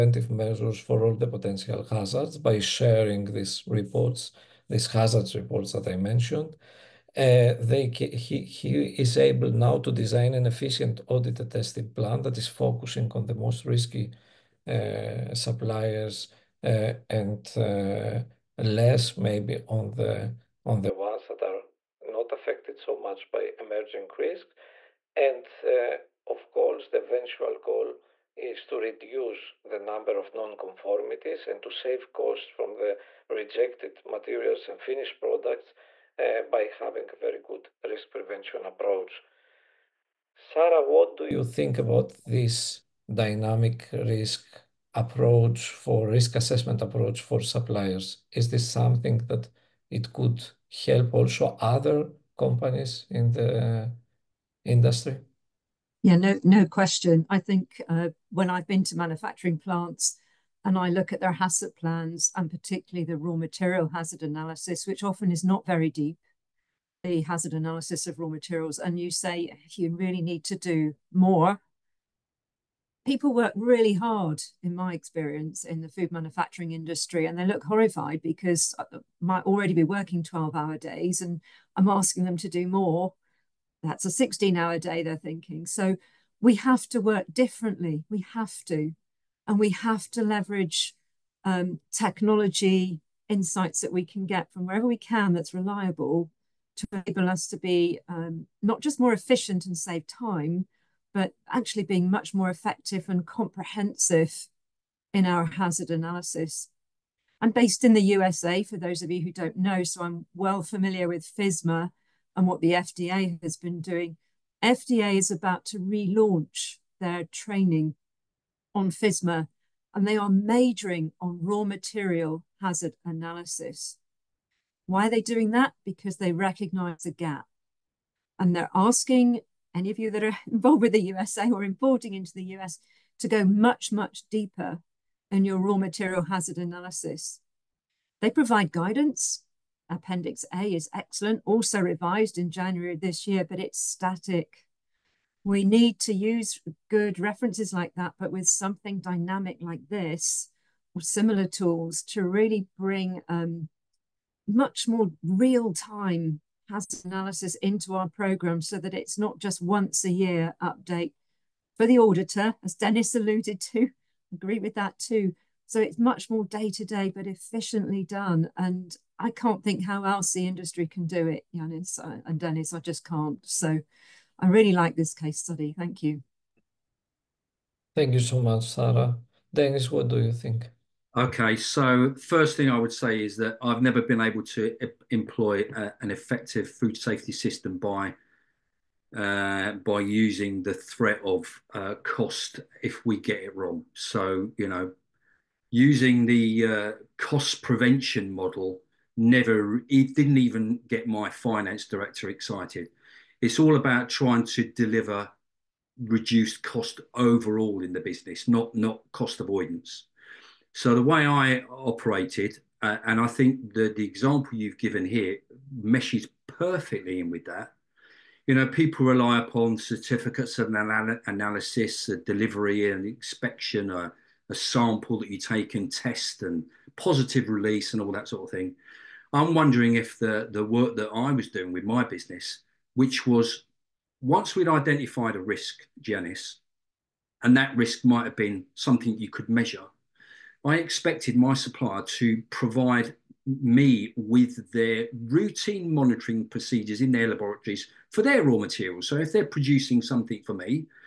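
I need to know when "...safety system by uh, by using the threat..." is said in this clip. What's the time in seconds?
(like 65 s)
186 s.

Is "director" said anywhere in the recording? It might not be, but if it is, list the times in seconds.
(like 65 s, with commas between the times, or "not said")
201 s.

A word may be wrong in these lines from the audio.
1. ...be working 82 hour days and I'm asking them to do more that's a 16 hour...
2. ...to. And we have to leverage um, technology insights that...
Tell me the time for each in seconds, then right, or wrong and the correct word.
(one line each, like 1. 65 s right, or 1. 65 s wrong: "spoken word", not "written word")
1. 79 s wrong: "12", not "82"
2. 88 s right.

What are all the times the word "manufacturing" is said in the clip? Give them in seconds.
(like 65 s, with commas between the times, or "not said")
58 s, 76 s.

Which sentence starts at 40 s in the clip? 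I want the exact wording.
Sara, what do you think about this dynamic risk approach for risk assessment approach for suppliers?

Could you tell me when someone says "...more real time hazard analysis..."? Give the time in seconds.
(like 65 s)
154 s.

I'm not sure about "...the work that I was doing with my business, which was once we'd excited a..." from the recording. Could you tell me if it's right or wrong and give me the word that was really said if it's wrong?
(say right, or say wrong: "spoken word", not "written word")
wrong: "identified", not "excited".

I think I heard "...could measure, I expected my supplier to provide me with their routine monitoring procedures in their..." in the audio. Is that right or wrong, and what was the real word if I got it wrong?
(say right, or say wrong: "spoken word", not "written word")
right.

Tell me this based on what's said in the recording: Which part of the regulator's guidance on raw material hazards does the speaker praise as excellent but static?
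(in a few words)
Appendix A.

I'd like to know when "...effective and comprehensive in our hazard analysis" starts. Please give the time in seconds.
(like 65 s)
102 s.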